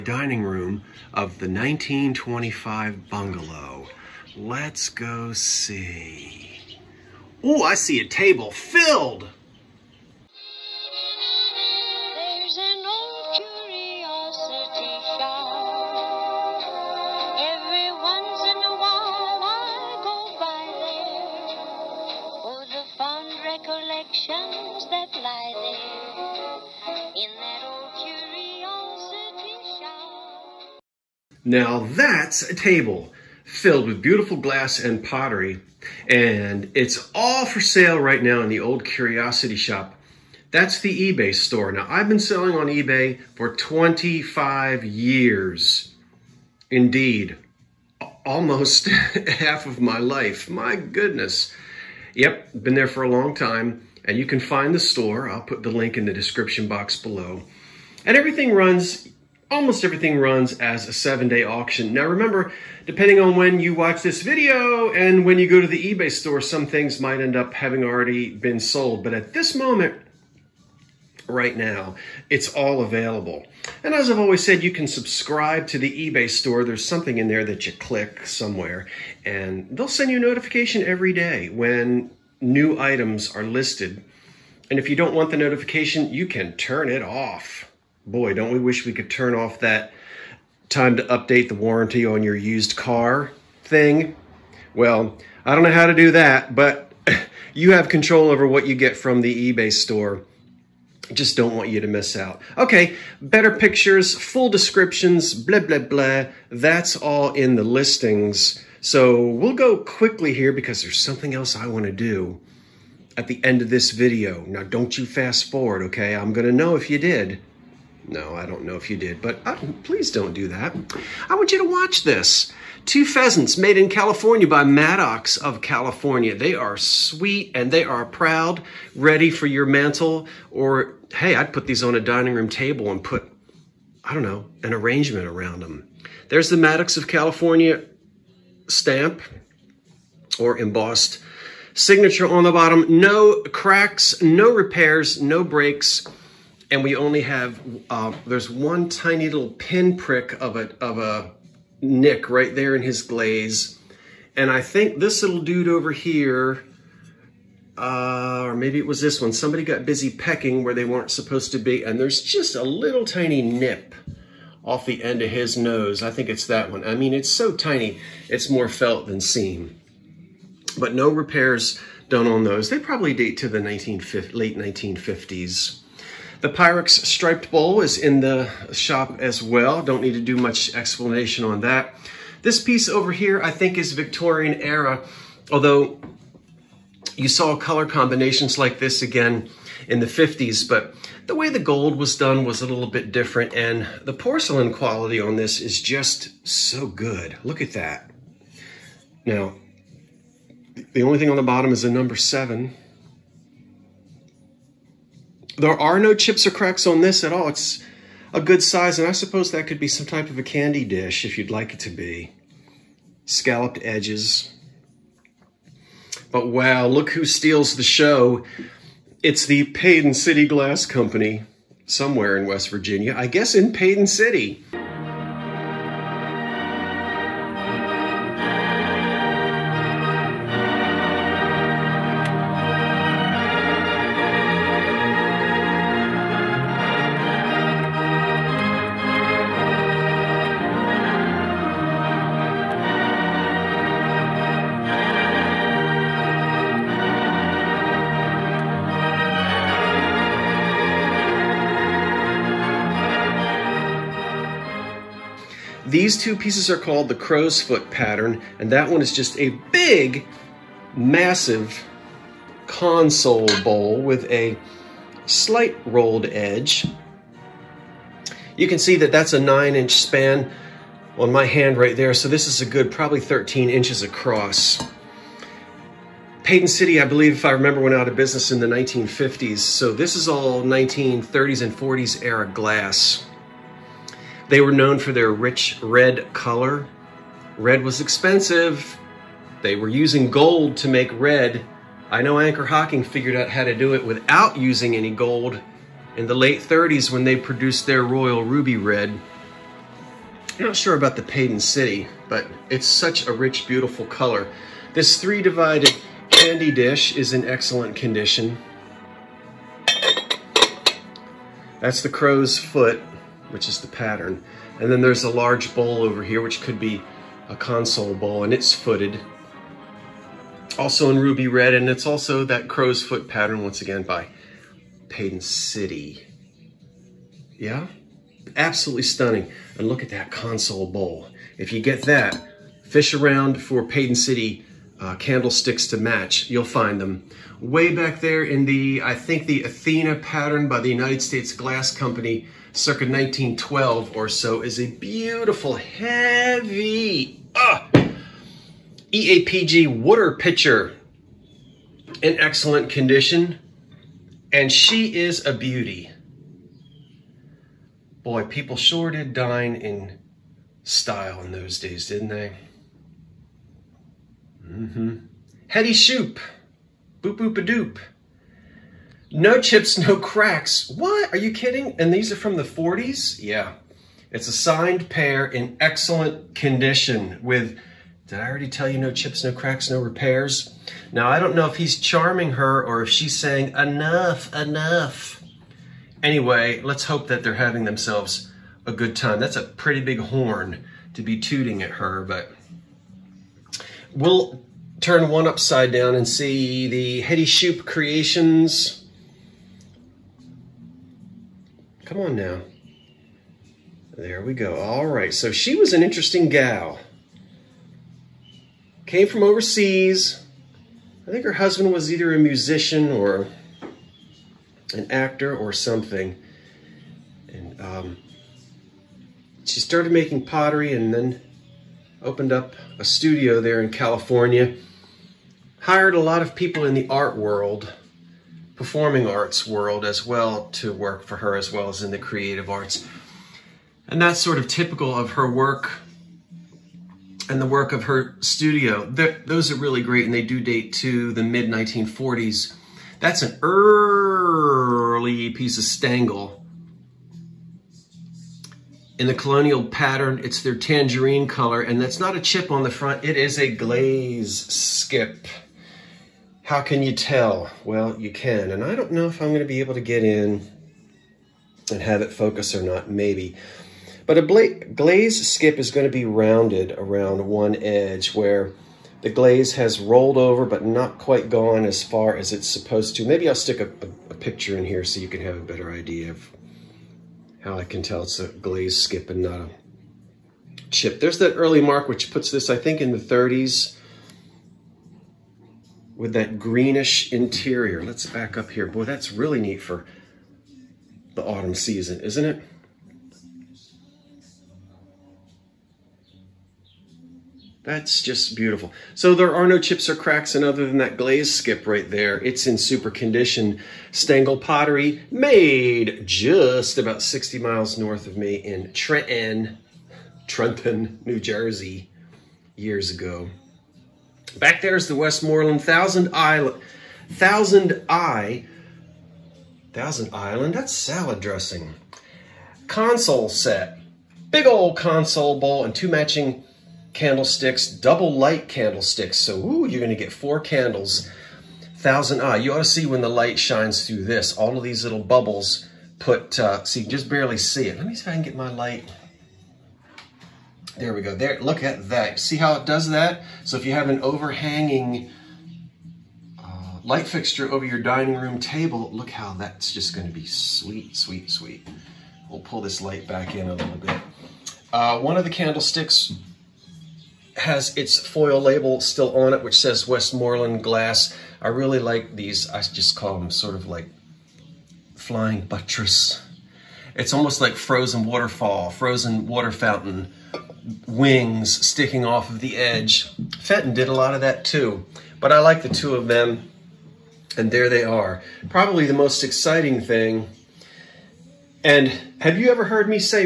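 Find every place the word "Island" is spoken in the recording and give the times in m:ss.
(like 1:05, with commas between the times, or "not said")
8:36, 8:40.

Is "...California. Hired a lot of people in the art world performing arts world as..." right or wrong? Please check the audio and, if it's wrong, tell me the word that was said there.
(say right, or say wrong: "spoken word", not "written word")
right.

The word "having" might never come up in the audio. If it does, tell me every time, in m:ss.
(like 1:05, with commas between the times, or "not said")
1:07, 6:27.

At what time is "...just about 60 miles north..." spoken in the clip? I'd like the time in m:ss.
8:26.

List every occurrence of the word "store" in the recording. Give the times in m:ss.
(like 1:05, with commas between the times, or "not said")
0:41, 0:54, 1:06, 1:16, 1:39.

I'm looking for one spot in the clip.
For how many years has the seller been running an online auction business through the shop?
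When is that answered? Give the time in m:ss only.
0:43.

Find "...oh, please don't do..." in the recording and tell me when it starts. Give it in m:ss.
1:59.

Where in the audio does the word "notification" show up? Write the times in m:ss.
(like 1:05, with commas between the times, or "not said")
1:20, 1:25.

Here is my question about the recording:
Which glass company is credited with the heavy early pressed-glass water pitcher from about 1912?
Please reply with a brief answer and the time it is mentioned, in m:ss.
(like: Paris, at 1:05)
United States Glass Company, at 5:40.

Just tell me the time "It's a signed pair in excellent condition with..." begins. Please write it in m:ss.
6:14.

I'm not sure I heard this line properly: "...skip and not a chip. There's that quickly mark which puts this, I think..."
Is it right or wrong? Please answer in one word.
wrong.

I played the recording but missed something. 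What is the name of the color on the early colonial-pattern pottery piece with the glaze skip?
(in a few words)
Tangerine.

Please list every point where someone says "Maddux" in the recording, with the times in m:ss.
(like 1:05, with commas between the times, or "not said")
2:04, 2:16.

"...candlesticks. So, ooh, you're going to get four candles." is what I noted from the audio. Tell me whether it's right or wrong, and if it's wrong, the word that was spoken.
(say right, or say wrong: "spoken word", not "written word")
right.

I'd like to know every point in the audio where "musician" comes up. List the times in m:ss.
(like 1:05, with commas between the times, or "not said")
6:52.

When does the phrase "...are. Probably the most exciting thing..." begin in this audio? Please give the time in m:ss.
9:38.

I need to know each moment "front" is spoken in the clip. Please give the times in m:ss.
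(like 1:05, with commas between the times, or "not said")
7:32.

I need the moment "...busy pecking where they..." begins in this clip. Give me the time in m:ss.
2:39.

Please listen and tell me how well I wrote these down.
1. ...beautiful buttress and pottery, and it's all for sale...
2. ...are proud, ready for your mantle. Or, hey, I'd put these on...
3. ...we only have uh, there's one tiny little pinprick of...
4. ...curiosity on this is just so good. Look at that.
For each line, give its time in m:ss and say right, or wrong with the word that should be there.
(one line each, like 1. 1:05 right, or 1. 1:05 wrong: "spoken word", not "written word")
1. 0:33 wrong: "glass", not "buttress"
2. 2:07 right
3. 2:26 right
4. 3:14 wrong: "quality", not "curiosity".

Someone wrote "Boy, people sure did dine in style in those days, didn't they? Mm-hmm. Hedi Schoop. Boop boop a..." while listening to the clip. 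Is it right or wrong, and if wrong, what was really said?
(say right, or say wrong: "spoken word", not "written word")
right.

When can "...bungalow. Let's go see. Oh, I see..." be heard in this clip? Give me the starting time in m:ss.
0:03.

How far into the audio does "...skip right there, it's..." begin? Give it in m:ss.
8:21.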